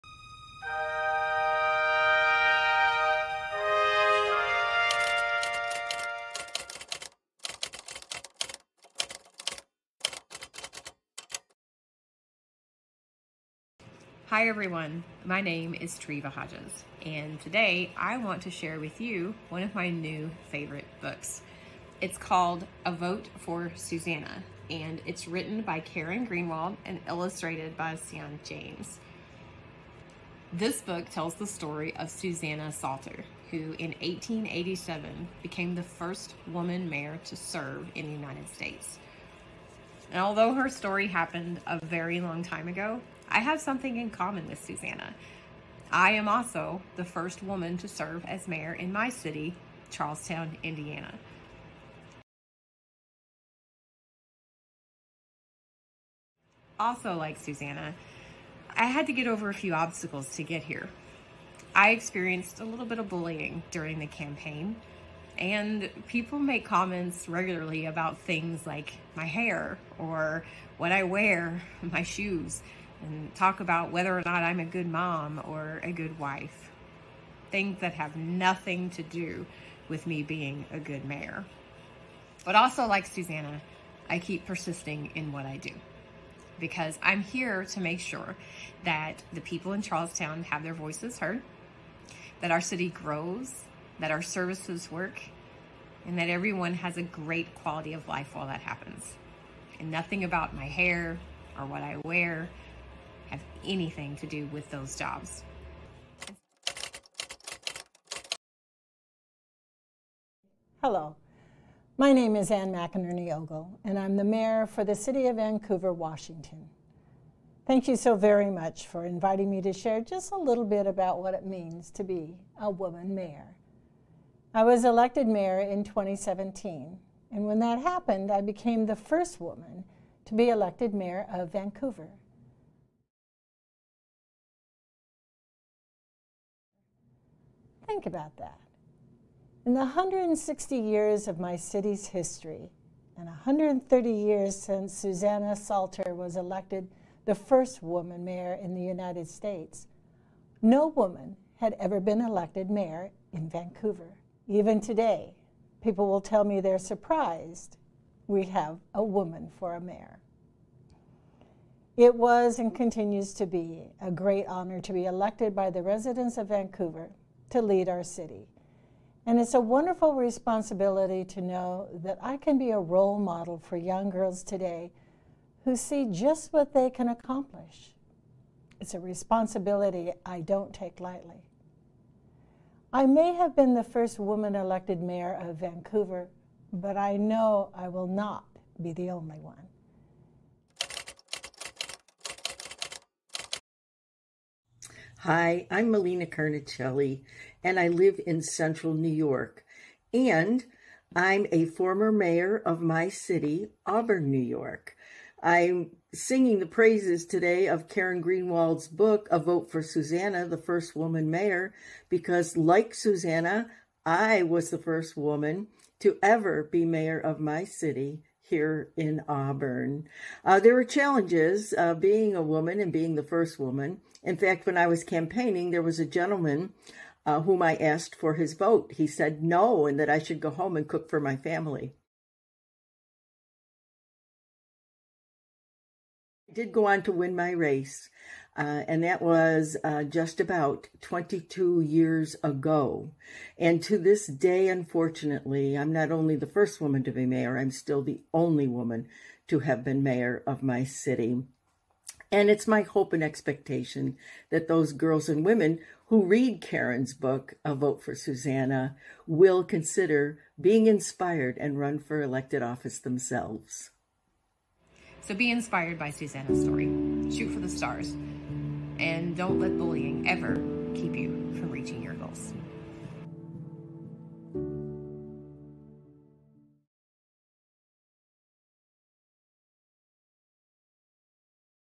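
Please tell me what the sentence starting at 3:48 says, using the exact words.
He said no and that I should go home and cook for my family.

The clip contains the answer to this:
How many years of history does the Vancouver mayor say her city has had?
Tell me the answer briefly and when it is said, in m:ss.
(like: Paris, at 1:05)
160, at 2:19.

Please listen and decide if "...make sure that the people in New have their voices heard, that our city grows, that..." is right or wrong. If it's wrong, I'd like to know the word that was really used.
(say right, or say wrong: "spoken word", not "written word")
wrong: "Charlestown", not "New".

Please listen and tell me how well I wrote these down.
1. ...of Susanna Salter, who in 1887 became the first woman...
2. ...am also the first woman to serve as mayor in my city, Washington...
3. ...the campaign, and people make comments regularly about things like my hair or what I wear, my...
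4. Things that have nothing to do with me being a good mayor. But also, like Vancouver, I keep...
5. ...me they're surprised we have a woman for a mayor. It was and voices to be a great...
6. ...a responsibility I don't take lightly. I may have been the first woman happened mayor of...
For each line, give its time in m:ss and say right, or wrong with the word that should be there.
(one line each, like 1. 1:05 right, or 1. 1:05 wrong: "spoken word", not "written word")
1. 0:31 right
2. 0:46 wrong: "Charlestown", not "Washington"
3. 1:03 right
4. 1:17 wrong: "Susanna", not "Vancouver"
5. 2:36 wrong: "continues", not "voices"
6. 2:58 wrong: "elected", not "happened".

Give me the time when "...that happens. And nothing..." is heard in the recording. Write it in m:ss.
1:38.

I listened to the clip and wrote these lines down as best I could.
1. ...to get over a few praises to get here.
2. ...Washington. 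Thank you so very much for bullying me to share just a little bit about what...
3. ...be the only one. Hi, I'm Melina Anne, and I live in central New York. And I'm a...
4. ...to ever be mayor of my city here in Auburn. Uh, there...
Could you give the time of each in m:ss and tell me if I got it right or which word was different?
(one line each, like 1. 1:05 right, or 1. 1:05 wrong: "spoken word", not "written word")
1. 0:59 wrong: "obstacles", not "praises"
2. 1:55 wrong: "inviting", not "bullying"
3. 3:08 wrong: "Carnicelli", not "Anne"
4. 3:35 right.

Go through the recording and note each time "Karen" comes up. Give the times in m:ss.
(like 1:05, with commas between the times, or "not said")
0:25, 3:27, 4:16.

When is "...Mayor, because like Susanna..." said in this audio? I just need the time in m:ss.
3:31.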